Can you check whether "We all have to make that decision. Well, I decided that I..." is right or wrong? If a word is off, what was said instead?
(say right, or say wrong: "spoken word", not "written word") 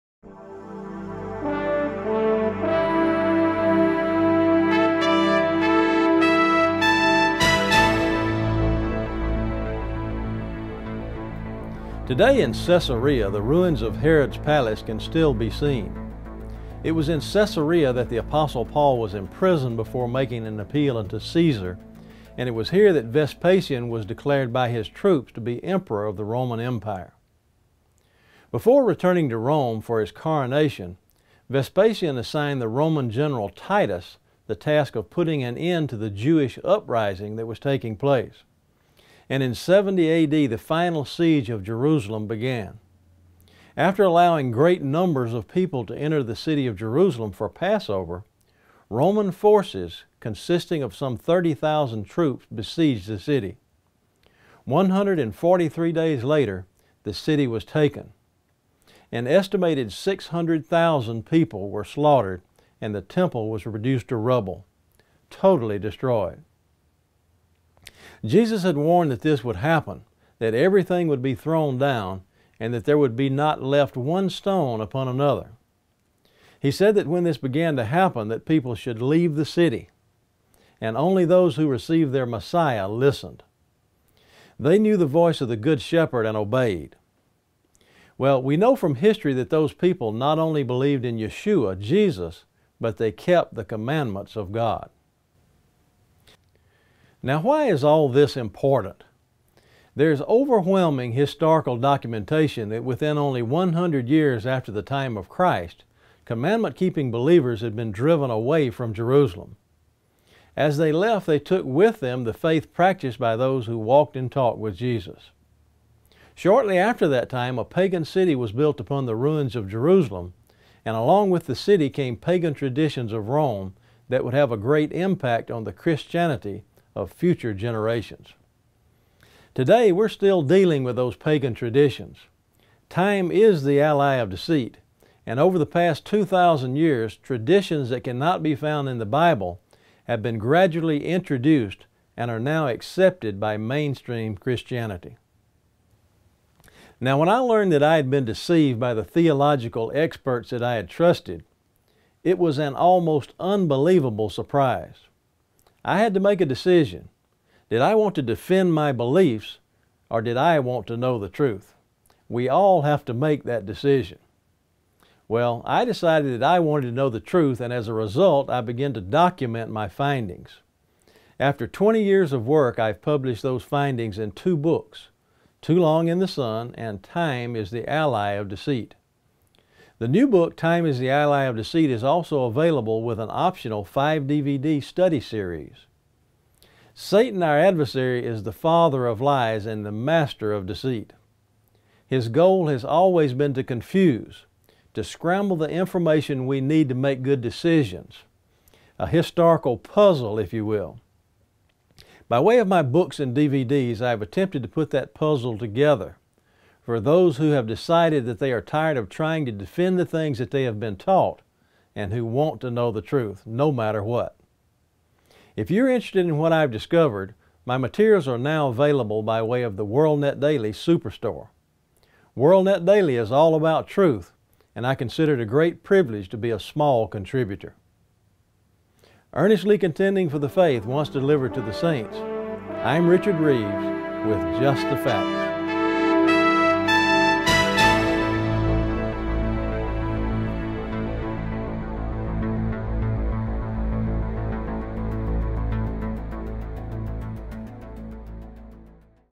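right.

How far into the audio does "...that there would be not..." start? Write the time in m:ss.
1:12.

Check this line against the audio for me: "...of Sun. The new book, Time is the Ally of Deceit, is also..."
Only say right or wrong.
wrong.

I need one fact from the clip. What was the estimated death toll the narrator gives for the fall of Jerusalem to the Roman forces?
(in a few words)
600,000.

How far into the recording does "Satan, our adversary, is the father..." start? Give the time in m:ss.
3:06.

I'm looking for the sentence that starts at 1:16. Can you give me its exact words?
He said that when this began to happen, that people should leave the city, and only those who received their Messiah listened.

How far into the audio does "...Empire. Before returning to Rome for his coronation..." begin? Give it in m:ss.
0:26.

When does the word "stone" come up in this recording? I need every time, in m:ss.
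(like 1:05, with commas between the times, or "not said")
1:14.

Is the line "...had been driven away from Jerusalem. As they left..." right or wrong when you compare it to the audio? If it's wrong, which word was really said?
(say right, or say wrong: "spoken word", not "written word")
right.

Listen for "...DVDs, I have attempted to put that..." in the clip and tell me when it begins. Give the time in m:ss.
3:23.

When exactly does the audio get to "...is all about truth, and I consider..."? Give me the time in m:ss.
3:43.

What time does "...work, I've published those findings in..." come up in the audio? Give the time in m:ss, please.
2:52.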